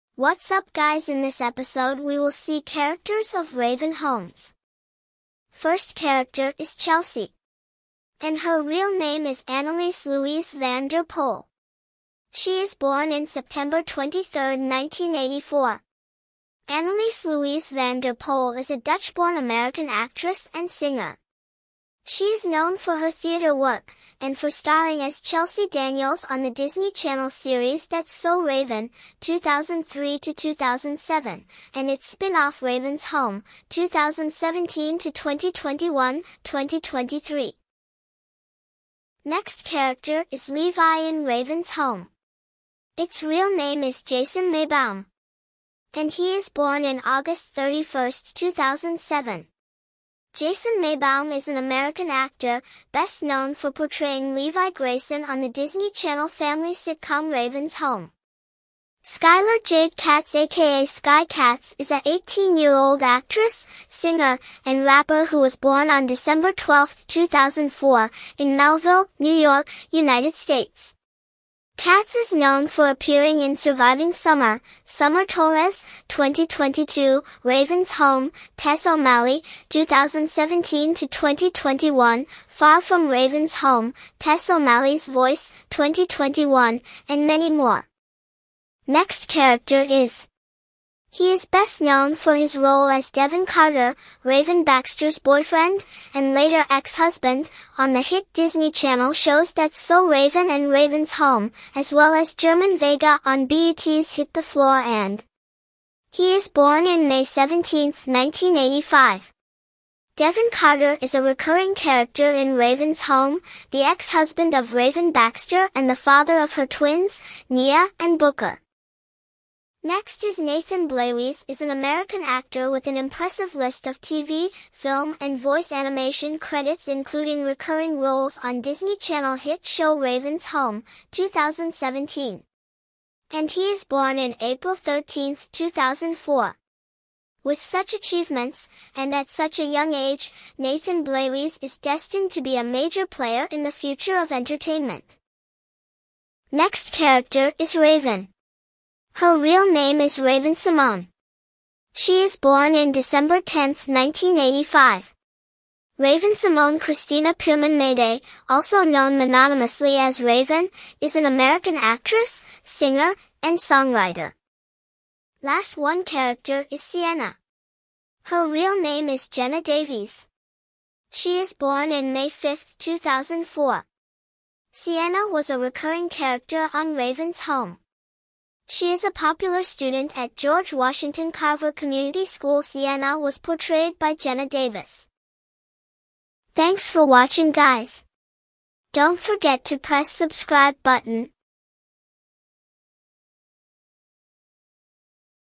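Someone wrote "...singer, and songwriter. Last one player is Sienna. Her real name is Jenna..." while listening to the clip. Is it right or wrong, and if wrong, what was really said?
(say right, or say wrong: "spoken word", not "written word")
wrong: "character", not "player".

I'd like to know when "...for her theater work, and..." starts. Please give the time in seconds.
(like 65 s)
22 s.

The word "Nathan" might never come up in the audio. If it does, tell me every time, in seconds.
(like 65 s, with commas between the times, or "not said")
120 s, 140 s.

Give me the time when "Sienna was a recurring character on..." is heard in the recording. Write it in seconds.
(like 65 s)
174 s.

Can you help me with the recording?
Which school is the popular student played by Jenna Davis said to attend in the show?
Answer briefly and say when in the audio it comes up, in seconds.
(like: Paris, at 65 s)
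George Washington Carver Community School, at 180 s.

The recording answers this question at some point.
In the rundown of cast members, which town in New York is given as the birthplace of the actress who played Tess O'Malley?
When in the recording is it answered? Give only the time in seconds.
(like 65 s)
68 s.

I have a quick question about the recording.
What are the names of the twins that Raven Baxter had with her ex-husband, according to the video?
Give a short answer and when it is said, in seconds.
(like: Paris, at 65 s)
Nia and Booker, at 117 s.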